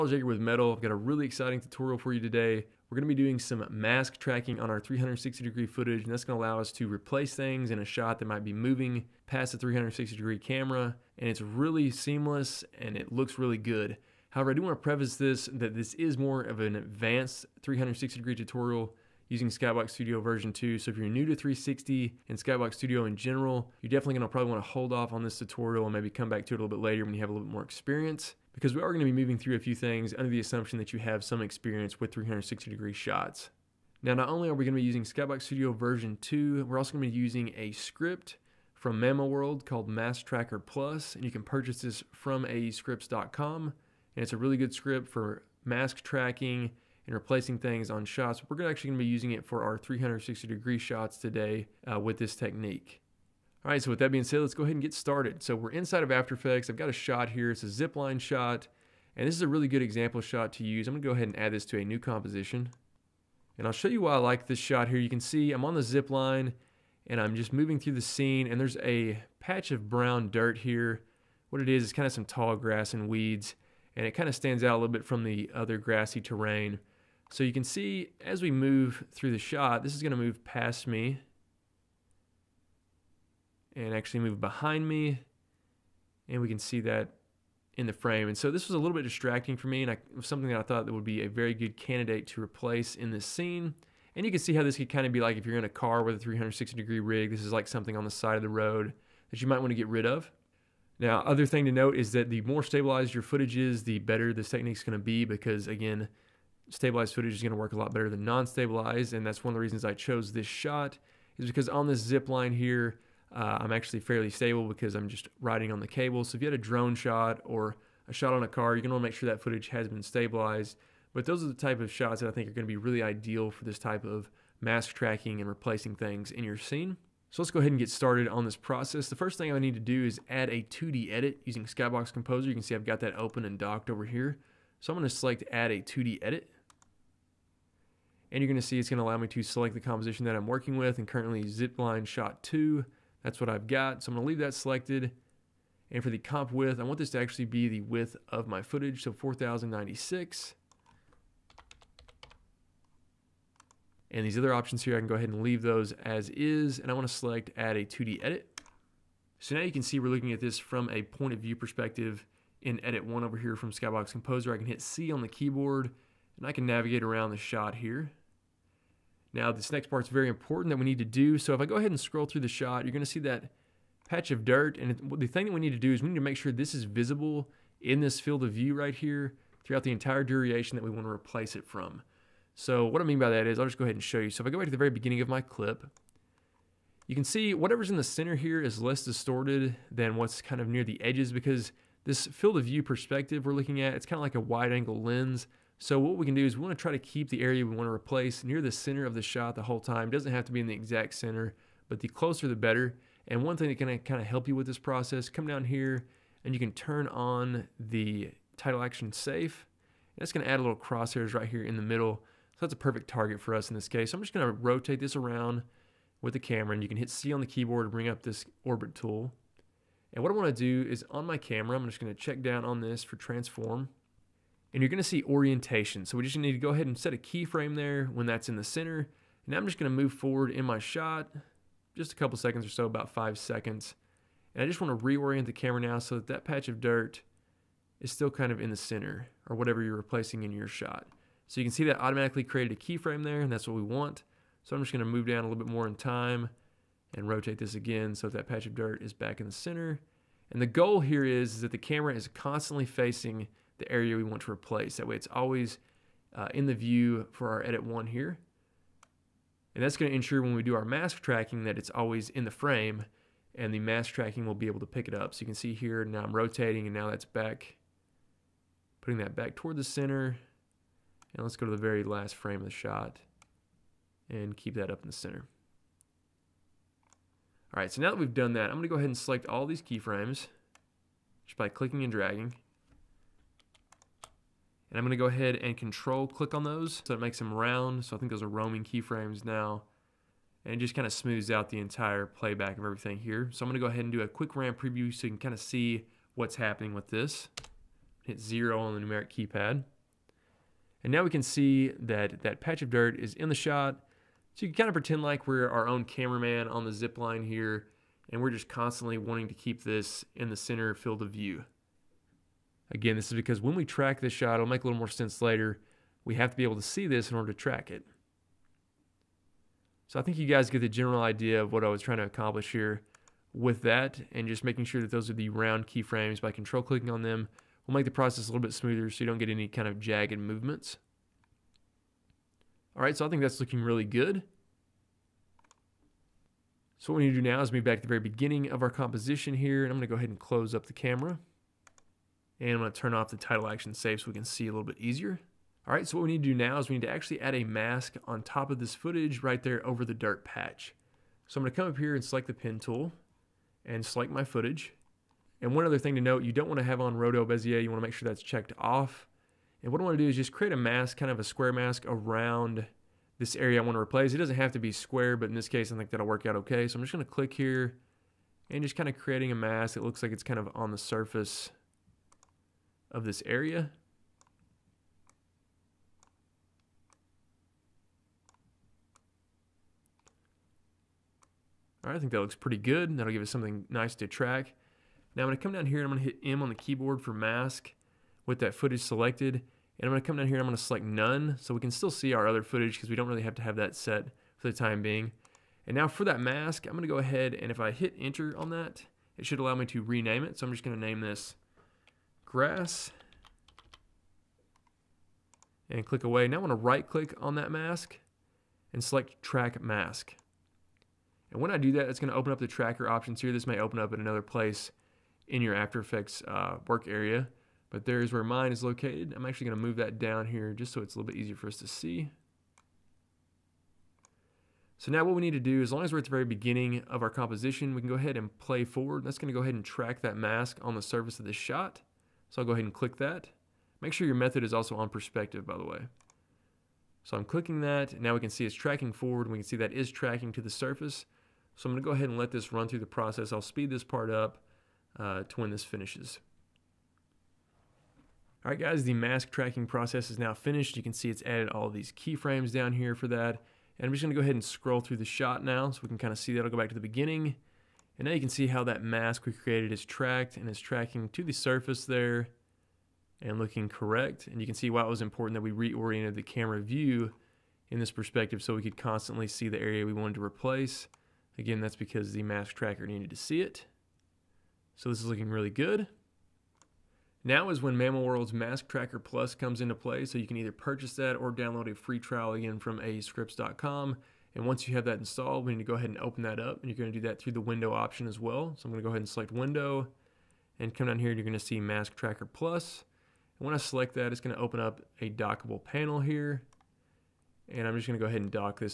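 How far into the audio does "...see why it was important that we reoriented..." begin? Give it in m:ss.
7:44.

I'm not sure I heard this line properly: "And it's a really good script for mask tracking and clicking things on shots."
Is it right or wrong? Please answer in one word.
wrong.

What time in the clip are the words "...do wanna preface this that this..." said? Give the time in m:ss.
0:14.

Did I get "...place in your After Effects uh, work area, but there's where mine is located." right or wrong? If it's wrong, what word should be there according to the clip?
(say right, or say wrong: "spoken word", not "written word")
right.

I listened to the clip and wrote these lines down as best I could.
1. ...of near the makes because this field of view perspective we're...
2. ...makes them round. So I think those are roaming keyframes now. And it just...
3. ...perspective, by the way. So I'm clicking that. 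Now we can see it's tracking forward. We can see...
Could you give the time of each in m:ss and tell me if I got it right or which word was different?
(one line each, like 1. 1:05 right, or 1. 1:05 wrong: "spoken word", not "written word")
1. 3:10 wrong: "edges", not "makes"
2. 4:47 right
3. 7:15 right.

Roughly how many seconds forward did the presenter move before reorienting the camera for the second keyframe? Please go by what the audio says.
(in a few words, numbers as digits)
About 5 seconds.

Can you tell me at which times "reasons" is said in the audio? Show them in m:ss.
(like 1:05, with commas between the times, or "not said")
1:49.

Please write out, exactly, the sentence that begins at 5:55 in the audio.
And one other thing to note, you don't want to have on Roto Bezier.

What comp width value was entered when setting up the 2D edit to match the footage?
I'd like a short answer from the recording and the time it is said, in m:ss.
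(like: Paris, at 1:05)
4096, at 2:29.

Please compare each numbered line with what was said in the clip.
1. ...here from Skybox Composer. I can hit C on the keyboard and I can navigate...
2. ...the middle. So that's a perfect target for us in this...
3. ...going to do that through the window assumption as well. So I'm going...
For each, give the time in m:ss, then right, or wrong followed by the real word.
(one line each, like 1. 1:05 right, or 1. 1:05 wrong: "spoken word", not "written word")
1. 2:43 right
2. 3:31 right
3. 8:06 wrong: "option", not "assumption".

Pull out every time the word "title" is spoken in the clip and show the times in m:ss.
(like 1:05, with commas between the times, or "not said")
3:28, 5:43.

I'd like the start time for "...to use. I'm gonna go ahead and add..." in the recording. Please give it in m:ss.
1:00.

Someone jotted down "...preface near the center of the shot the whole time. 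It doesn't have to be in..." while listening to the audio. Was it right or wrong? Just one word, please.
wrong.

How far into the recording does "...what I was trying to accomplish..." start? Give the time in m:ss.
5:21.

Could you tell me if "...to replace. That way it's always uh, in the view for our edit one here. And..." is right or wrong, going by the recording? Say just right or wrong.
right.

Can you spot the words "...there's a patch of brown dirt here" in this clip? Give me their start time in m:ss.
1:08.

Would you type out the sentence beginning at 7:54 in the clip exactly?
So this is looking really good.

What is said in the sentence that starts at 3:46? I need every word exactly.
So we just need to go ahead and set a keyframe there when that's in the center.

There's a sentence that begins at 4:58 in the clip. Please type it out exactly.
Hit zero on the numeric keypad.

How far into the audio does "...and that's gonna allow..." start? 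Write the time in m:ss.
0:06.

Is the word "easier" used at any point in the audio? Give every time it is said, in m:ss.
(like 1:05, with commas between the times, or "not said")
5:45, 7:01.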